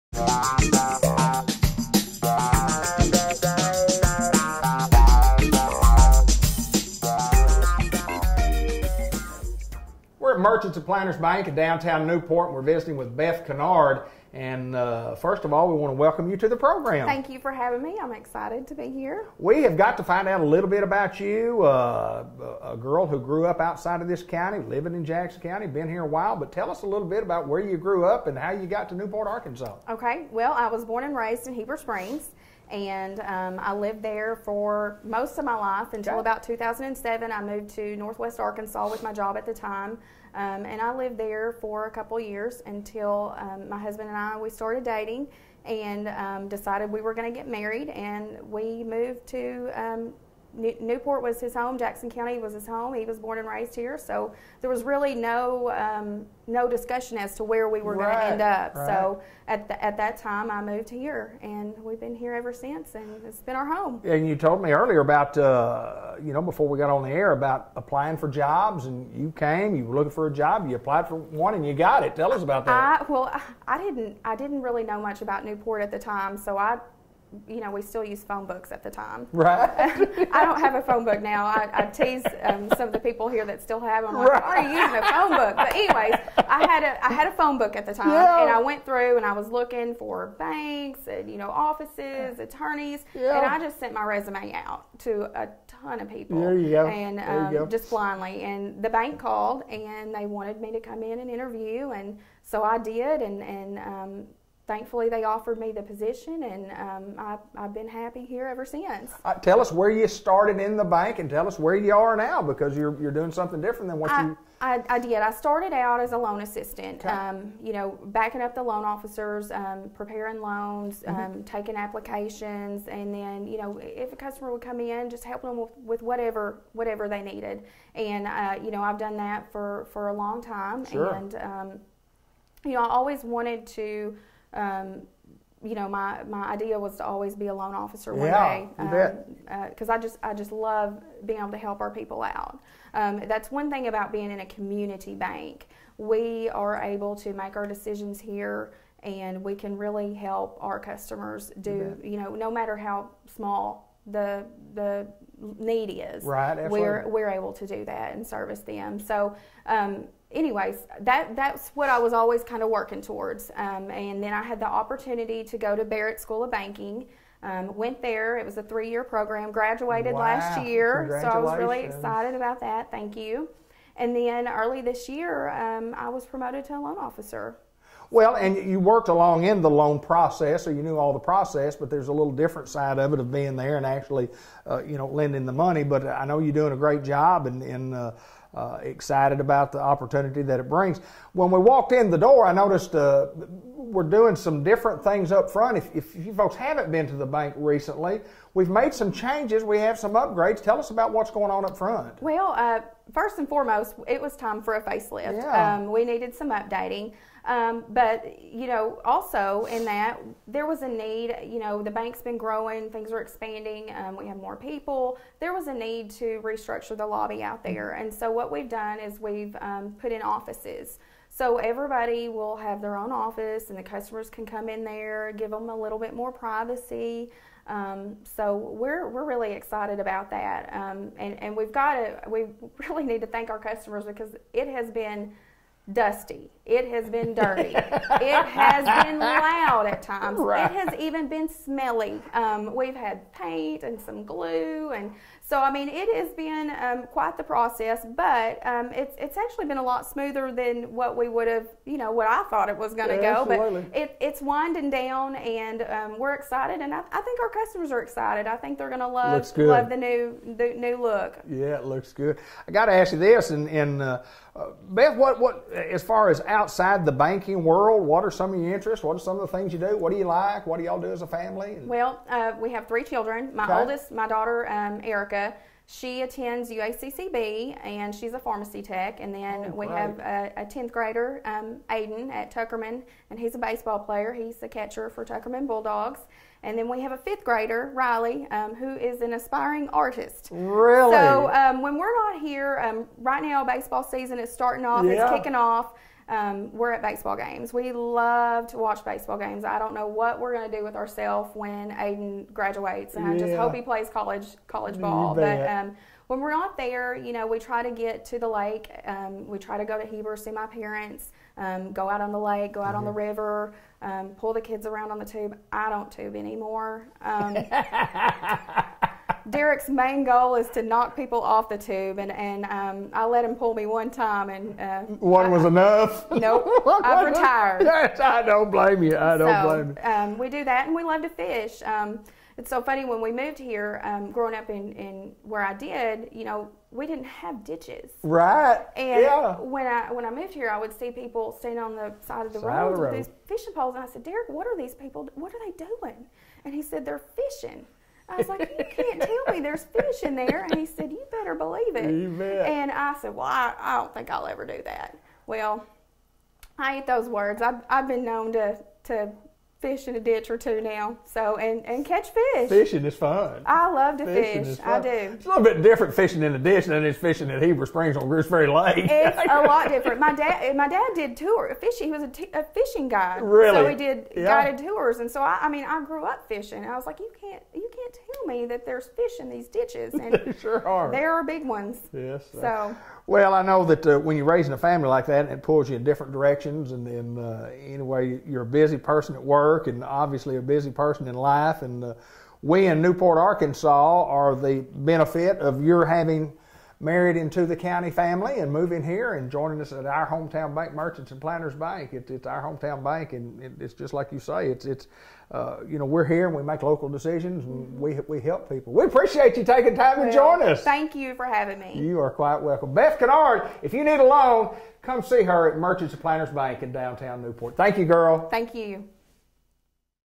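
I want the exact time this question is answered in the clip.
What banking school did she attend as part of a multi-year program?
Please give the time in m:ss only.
2:45.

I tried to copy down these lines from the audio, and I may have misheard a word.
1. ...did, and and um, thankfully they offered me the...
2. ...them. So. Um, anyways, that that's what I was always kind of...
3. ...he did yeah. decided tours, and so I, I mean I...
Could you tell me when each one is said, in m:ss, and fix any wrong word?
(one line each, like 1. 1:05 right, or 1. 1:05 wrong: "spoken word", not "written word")
1. 1:42 right
2. 2:38 right
3. 6:13 wrong: "guided", not "decided".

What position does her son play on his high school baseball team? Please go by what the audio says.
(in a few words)
Catcher.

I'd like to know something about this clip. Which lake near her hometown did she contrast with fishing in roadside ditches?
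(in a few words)
Greers Ferry Lake.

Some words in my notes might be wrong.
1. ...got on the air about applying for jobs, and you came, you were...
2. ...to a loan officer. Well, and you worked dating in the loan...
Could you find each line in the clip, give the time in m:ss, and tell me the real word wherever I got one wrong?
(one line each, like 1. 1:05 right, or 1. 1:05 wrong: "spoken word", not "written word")
1. 1:06 right
2. 2:56 wrong: "along", not "dating".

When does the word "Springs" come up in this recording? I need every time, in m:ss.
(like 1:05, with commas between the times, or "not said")
0:31, 6:07.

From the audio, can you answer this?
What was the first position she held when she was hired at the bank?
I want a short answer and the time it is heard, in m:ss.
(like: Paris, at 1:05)
Loan assistant, at 1:56.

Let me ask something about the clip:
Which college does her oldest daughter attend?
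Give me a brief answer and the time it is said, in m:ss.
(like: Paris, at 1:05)
UACCB, at 4:36.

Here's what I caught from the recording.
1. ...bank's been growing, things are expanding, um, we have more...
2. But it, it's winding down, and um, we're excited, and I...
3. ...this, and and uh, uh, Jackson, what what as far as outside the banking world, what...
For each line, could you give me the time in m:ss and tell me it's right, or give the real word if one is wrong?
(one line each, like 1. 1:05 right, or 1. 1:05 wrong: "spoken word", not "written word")
1. 3:31 right
2. 4:13 right
3. 4:23 wrong: "Beth", not "Jackson".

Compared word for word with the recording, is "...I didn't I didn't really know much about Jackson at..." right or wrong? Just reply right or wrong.
wrong.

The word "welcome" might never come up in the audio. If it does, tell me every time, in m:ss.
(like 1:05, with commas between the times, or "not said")
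0:15, 6:52.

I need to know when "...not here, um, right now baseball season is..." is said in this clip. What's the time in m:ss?
4:52.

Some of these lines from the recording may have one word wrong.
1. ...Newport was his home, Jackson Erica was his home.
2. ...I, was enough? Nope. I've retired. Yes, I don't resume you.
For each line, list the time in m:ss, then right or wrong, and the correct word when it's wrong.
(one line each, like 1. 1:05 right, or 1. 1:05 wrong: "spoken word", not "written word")
1. 0:50 wrong: "County", not "Erica"
2. 5:25 wrong: "blame", not "resume".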